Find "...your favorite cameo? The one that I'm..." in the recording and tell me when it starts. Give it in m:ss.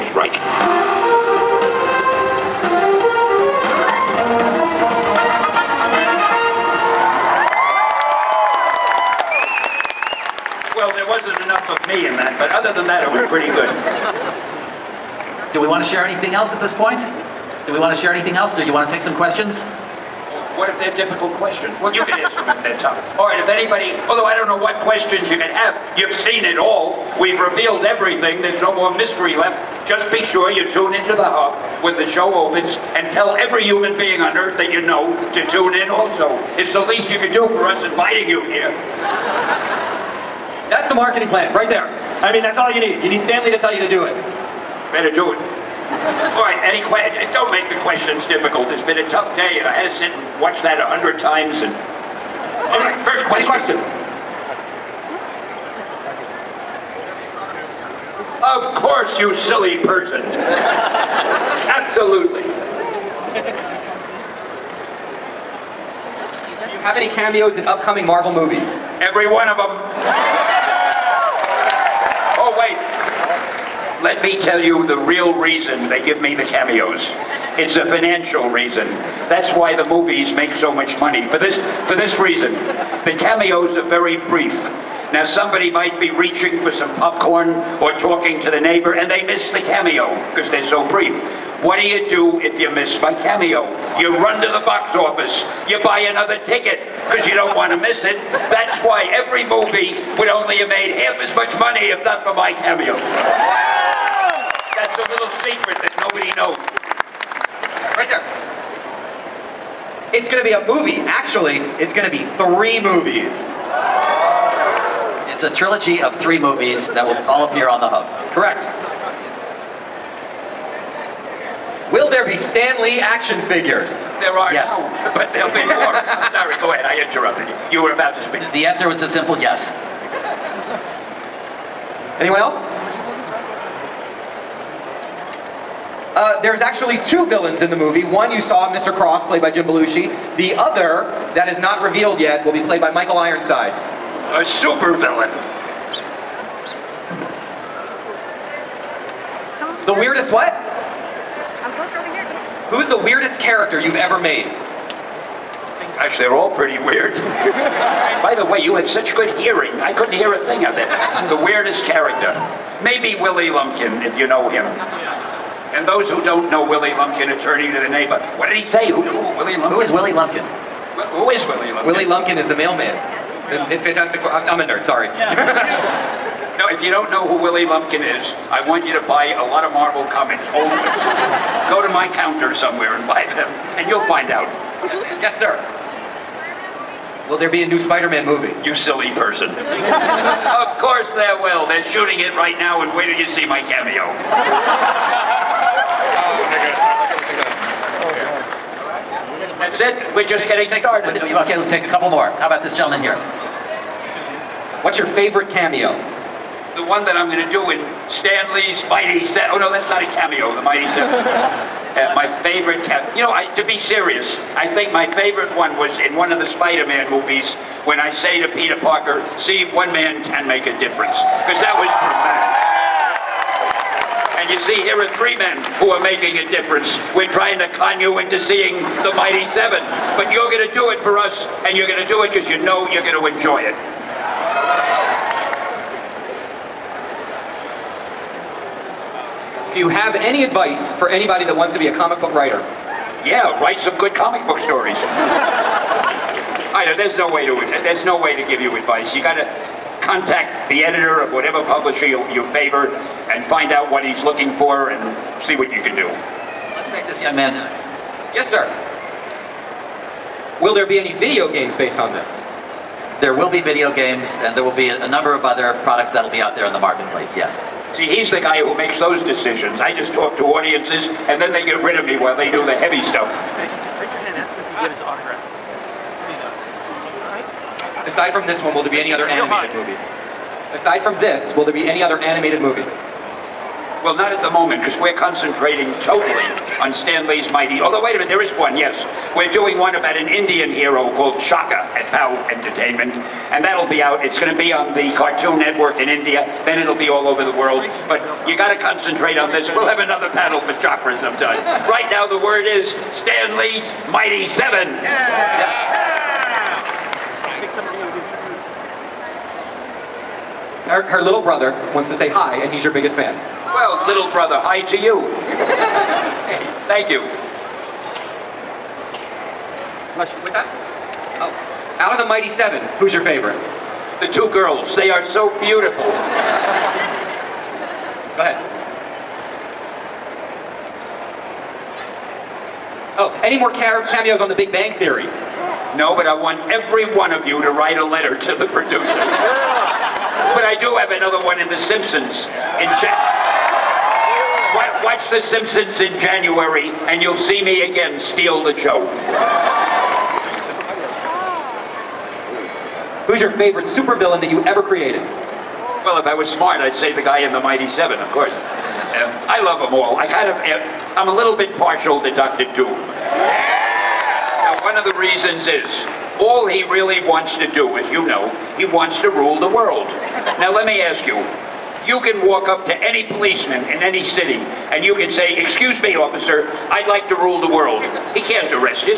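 3:24.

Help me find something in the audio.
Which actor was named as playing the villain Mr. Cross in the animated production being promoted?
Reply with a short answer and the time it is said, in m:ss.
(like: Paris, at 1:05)
Jim Belushi, at 2:19.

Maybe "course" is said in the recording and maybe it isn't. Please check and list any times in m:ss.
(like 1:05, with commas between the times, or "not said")
0:58, 3:10, 5:58.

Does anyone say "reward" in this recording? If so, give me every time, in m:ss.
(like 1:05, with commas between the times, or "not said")
not said.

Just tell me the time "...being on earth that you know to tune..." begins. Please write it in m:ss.
0:33.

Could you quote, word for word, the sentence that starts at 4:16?
Let's take this young man now.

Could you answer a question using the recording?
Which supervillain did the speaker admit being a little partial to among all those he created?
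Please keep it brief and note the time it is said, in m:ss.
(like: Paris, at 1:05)
Dr. Doom, at 6:02.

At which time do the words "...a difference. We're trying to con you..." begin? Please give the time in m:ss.
3:46.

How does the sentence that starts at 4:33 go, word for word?
Hey, raise your hand ask him if you get his autograph.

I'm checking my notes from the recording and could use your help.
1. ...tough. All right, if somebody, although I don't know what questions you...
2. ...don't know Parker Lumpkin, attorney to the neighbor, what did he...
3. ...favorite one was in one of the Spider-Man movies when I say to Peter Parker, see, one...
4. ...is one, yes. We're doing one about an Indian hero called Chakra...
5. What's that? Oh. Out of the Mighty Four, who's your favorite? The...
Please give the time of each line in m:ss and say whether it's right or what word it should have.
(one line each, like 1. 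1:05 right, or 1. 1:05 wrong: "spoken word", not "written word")
1. 0:22 wrong: "anybody", not "somebody"
2. 2:46 wrong: "Willie", not "Parker"
3. 3:35 right
4. 4:48 right
5. 5:20 wrong: "Seven", not "Four".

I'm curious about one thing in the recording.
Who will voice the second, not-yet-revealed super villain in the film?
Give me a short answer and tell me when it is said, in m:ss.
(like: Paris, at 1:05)
Michael Ironside, at 2:22.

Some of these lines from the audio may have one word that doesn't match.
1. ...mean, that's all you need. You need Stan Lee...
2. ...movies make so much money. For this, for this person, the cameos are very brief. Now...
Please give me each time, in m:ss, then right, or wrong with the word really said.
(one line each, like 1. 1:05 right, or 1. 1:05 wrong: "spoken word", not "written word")
1. 0:42 right
2. 1:19 wrong: "reason", not "person".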